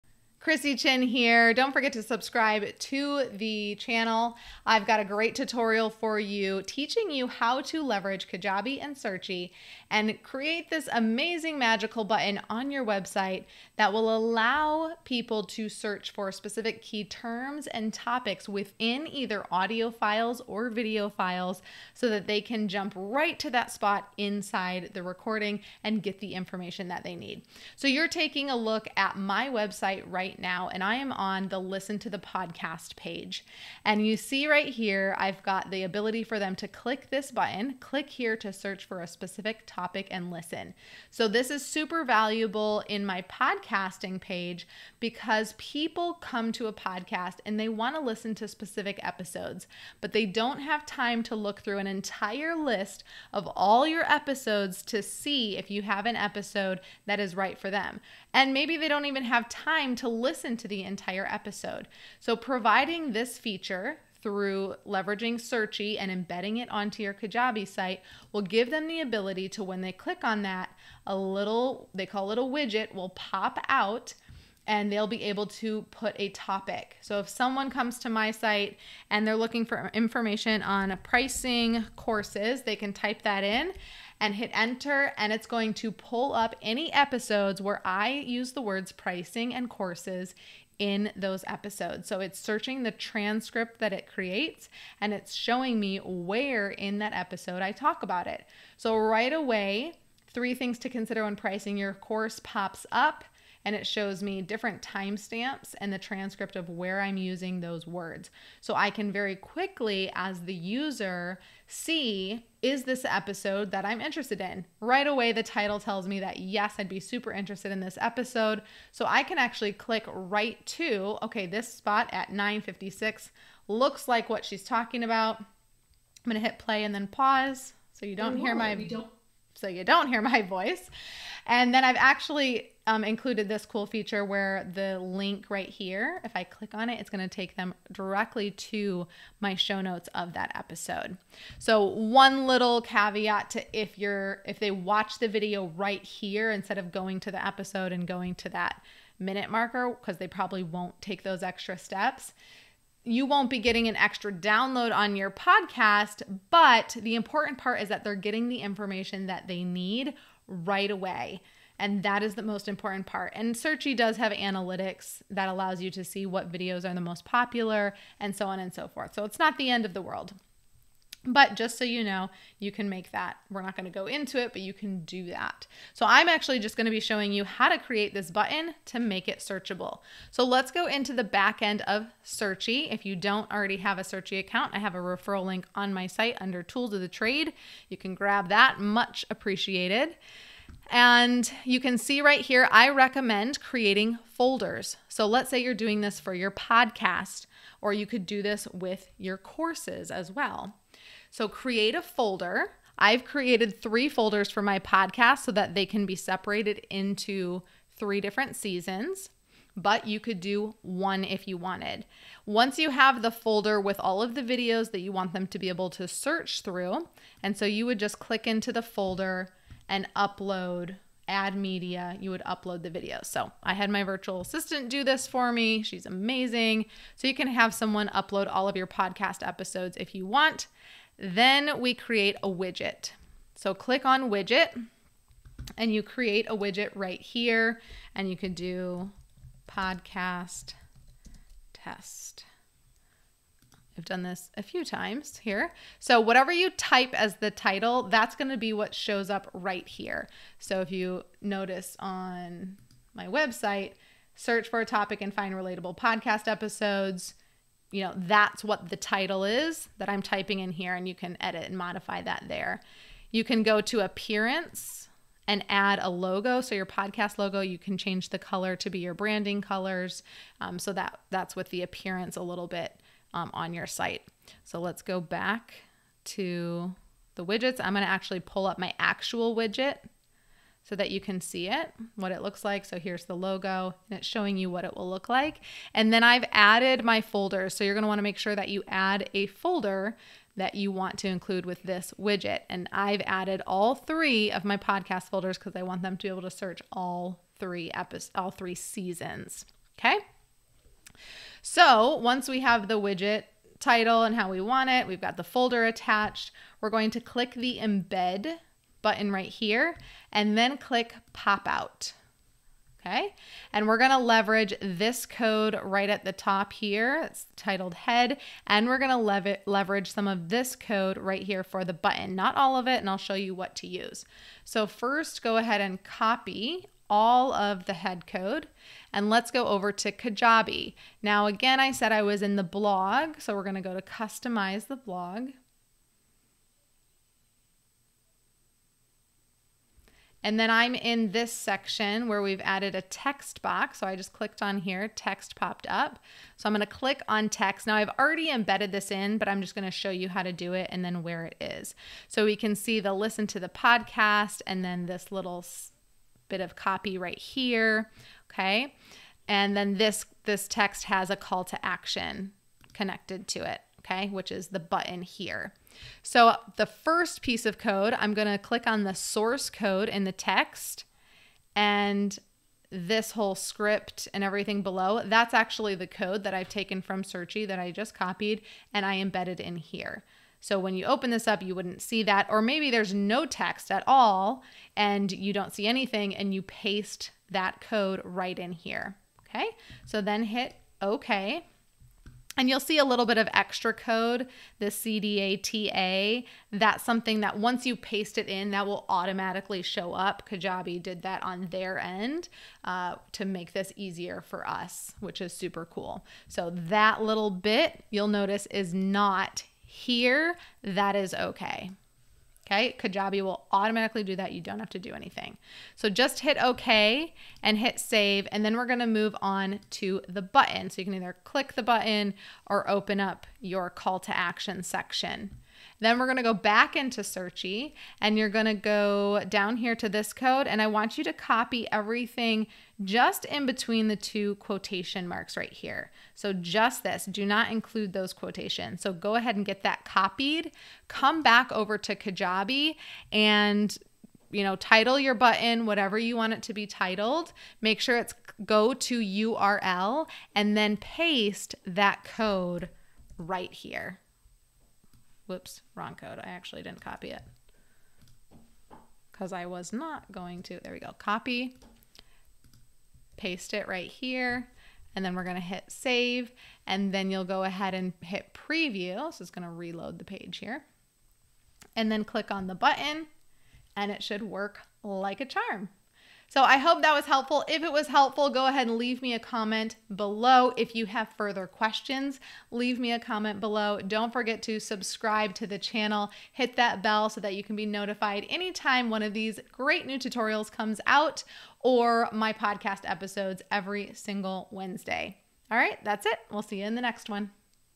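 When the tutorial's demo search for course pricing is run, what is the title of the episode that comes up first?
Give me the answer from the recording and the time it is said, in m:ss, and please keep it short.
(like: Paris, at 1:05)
Three things to consider when pricing your course, at 1:40.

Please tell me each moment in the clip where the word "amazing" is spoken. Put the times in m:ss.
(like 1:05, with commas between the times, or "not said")
0:10, 3:46.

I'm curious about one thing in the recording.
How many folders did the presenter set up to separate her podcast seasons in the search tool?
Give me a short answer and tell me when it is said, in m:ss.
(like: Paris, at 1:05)
3, at 3:23.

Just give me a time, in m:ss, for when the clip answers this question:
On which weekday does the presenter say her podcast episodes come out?
8:14.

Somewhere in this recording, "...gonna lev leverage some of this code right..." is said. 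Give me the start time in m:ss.
5:18.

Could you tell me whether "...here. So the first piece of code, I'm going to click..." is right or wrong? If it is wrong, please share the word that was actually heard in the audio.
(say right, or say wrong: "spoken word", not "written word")
right.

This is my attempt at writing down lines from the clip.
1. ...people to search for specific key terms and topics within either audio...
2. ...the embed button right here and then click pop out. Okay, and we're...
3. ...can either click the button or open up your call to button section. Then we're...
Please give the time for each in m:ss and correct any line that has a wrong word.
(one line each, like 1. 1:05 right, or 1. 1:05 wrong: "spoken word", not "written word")
1. 0:15 right
2. 5:07 right
3. 7:01 wrong: "action", not "button".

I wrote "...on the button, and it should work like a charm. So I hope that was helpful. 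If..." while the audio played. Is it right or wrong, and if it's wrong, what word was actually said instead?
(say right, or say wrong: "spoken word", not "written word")
right.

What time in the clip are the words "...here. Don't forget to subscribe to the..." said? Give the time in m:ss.
0:01.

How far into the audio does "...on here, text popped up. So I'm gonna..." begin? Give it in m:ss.
5:44.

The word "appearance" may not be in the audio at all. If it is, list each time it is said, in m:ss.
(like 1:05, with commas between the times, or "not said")
4:23, 4:31.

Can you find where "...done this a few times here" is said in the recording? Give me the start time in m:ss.
4:04.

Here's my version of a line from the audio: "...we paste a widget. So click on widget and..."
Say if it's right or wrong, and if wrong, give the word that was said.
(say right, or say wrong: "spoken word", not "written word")
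wrong: "create", not "paste".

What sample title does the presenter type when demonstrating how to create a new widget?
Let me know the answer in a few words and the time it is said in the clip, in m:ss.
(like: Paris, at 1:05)
podcast test, at 3:59.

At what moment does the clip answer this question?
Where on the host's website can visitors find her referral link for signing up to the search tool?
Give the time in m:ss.
3:06.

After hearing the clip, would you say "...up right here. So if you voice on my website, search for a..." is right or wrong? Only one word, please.
wrong.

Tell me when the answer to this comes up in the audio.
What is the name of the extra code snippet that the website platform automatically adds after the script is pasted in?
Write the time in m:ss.
6:34.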